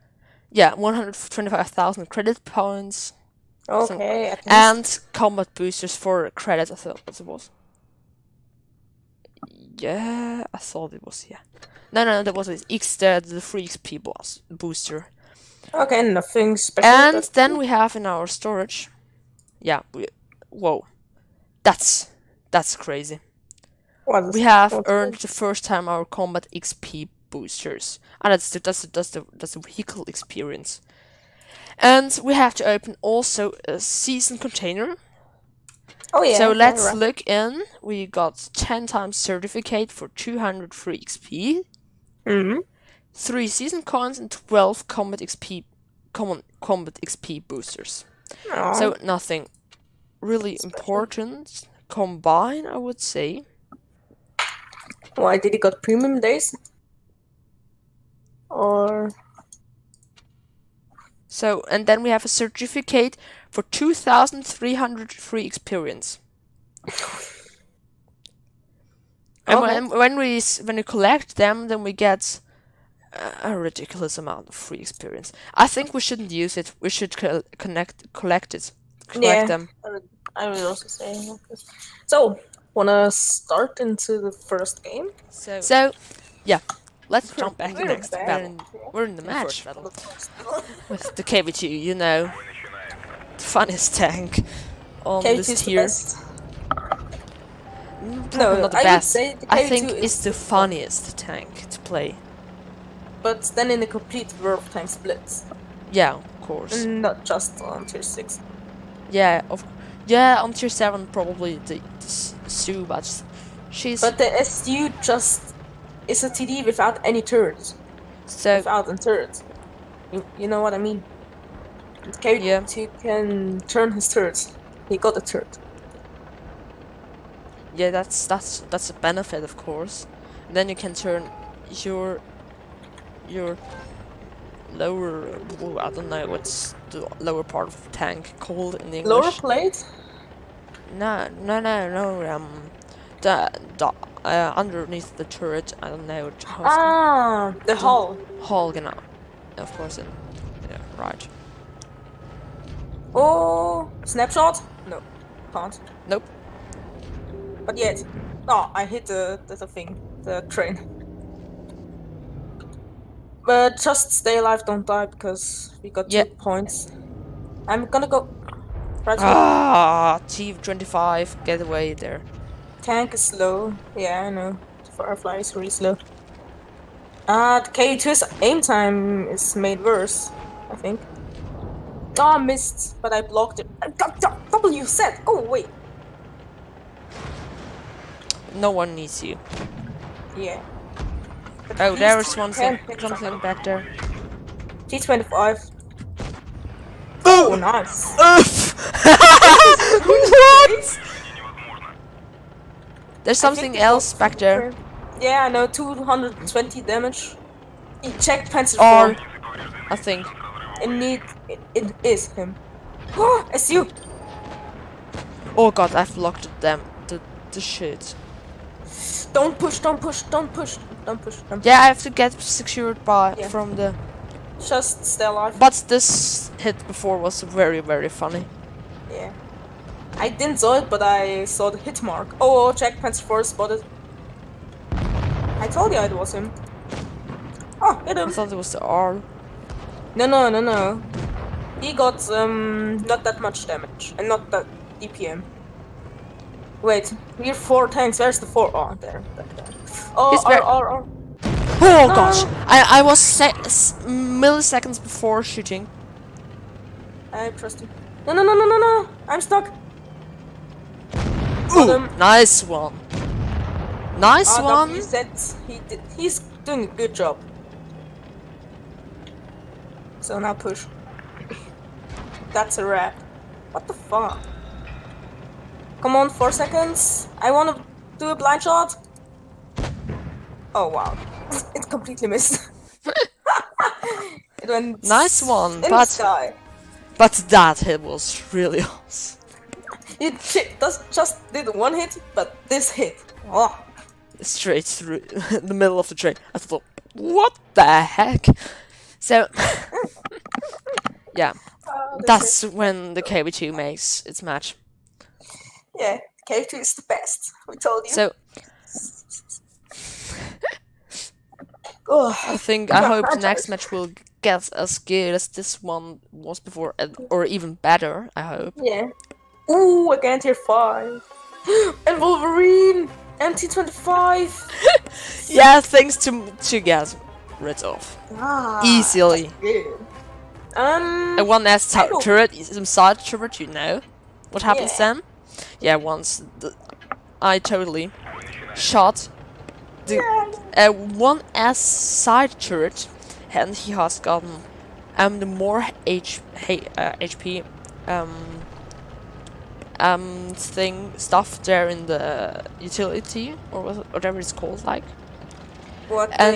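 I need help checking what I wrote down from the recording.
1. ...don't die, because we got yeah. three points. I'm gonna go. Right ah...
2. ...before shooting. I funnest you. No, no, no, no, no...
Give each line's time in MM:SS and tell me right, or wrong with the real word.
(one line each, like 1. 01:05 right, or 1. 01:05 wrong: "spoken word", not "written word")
1. 02:44 wrong: "two", not "three"
2. 04:15 wrong: "trust", not "funnest".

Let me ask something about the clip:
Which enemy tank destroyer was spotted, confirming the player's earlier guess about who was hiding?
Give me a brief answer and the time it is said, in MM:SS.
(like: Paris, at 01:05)
Jagdpanzer 4, at 03:52.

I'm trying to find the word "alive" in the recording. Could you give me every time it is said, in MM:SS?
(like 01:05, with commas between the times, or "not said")
02:44, 03:45.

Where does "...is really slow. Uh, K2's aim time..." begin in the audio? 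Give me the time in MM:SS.
02:55.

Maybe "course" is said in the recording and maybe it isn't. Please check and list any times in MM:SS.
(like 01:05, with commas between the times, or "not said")
01:46, 02:09, 02:29.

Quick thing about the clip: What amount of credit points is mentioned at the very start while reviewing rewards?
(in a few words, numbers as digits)
125,000.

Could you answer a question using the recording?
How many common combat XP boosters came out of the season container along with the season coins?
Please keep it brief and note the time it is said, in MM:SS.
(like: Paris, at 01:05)
12, at 00:44.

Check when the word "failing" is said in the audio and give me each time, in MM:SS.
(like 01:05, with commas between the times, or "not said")
not said.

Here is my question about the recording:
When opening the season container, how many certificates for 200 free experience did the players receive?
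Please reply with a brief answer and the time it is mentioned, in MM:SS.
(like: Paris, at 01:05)
10, at 00:38.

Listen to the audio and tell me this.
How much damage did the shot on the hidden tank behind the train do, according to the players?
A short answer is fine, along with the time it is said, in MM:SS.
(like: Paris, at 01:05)
220, at 03:25.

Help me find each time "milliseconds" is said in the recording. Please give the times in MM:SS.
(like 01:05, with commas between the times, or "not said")
04:13.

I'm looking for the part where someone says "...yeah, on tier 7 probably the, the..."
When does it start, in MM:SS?
01:50.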